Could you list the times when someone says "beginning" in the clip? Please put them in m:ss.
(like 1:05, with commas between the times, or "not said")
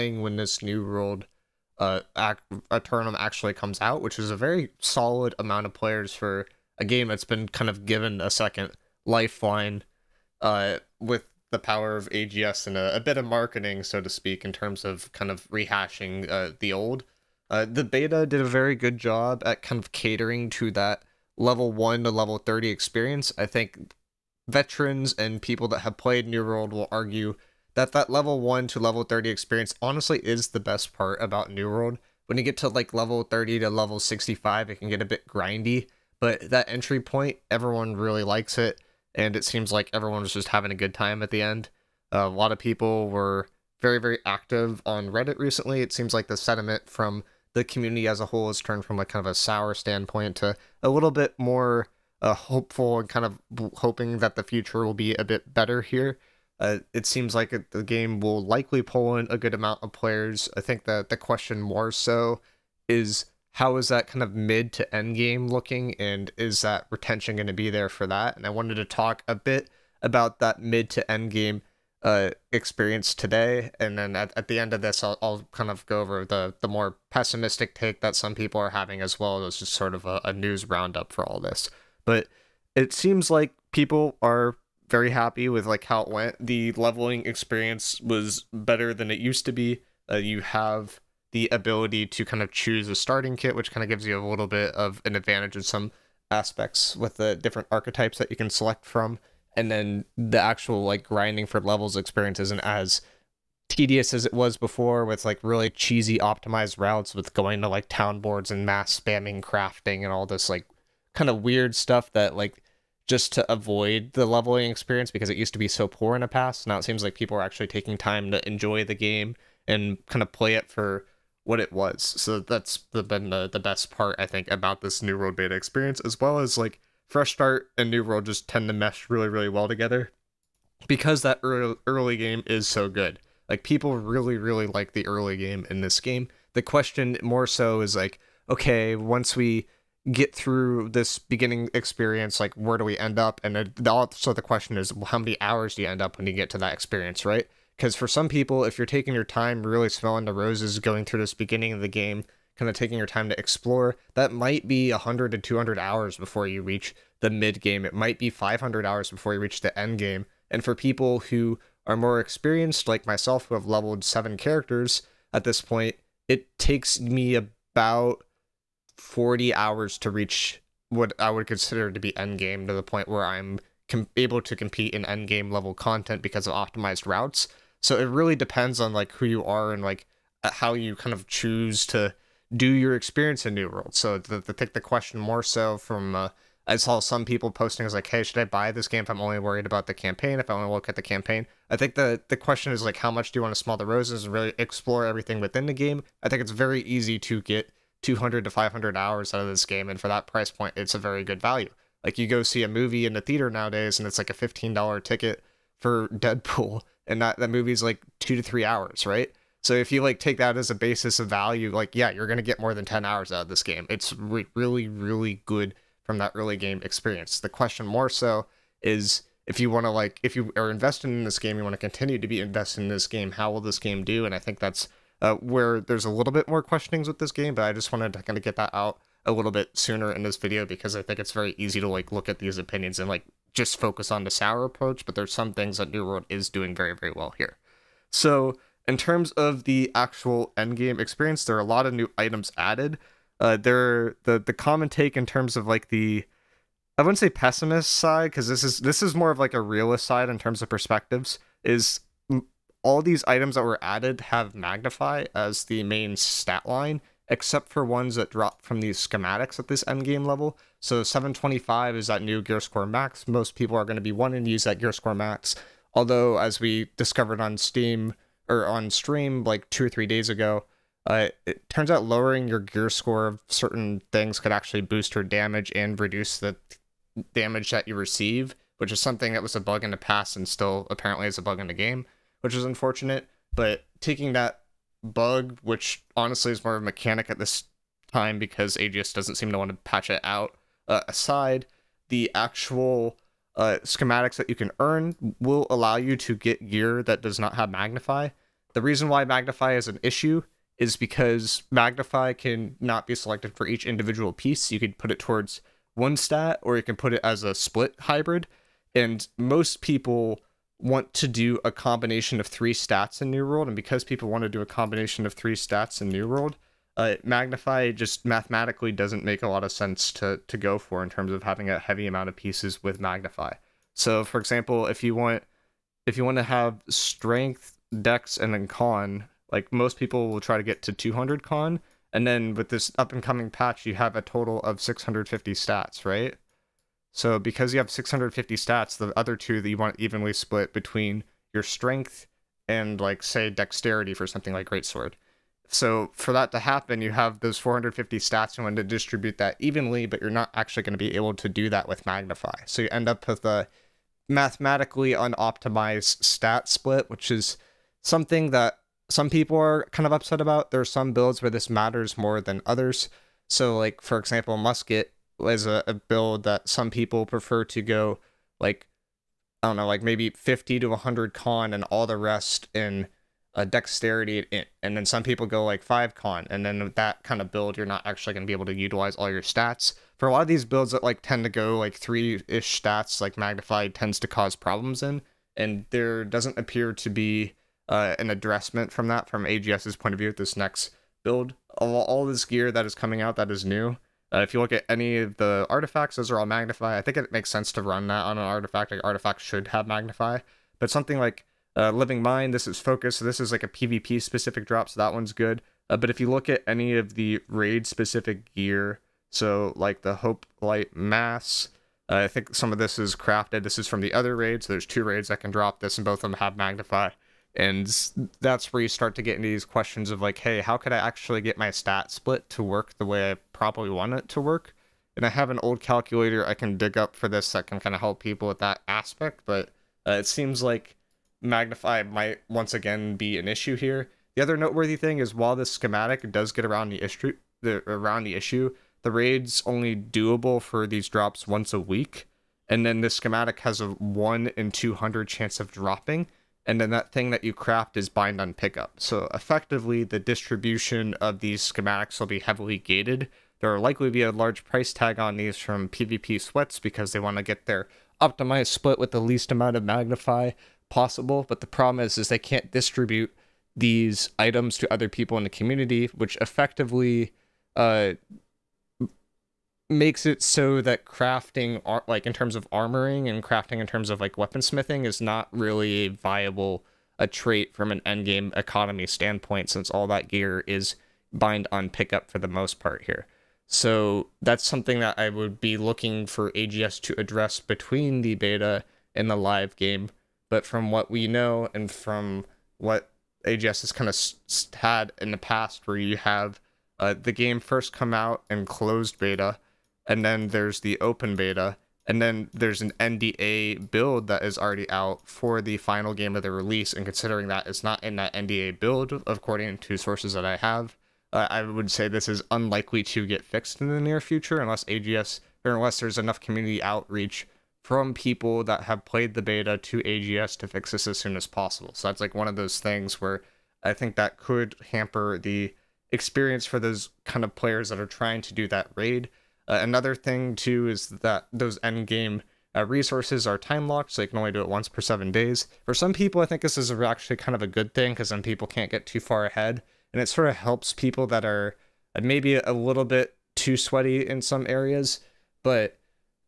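2:21, 2:31.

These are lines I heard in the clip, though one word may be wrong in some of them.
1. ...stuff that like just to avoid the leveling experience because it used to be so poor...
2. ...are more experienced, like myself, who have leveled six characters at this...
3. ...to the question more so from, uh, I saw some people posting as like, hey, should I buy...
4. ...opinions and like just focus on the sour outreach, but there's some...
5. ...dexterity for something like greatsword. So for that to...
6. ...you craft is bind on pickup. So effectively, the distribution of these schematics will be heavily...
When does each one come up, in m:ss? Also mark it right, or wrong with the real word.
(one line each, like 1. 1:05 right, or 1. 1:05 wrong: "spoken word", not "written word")
1. 1:51 right
2. 2:41 wrong: "seven", not "six"
3. 3:04 right
4. 3:52 wrong: "approach", not "outreach"
5. 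5:43 right
6. 7:27 right.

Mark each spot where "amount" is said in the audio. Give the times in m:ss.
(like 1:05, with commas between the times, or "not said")
0:05, 0:59, 5:22, 7:39.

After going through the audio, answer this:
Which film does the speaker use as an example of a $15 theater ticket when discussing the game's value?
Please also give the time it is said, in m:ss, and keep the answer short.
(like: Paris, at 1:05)
Deadpool, at 3:26.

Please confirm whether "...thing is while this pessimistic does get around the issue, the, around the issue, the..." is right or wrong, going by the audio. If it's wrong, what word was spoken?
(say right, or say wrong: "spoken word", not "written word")
wrong: "schematic", not "pessimistic".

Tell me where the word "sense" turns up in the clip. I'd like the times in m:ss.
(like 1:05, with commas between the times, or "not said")
5:19, 6:37.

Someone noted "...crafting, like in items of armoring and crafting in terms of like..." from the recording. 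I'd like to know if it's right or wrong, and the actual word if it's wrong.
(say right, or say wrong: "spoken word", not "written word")
wrong: "terms", not "items".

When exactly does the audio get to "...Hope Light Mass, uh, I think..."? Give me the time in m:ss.
6:50.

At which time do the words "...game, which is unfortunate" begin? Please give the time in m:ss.
4:41.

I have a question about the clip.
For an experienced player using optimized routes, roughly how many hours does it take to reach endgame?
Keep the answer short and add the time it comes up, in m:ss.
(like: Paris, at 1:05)
40 hours, at 2:48.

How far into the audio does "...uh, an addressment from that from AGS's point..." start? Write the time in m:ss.
6:27.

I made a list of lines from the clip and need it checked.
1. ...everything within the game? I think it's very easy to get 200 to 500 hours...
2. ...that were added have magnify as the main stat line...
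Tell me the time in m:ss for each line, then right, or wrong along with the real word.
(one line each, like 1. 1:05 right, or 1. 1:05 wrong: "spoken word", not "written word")
1. 3:15 right
2. 4:13 right.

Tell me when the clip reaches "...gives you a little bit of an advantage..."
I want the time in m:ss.
1:33.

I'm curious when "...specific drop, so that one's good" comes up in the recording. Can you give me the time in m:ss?
6:44.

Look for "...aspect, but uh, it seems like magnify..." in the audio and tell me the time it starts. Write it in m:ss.
7:08.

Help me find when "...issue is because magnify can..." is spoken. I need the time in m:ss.
5:00.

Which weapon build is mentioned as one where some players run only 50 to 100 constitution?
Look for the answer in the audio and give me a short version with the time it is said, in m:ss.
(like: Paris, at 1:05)
Musket, at 6:04.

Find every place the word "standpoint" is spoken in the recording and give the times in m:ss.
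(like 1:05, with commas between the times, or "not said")
0:49, 7:59.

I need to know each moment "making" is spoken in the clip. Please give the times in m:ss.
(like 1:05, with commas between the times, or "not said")
not said.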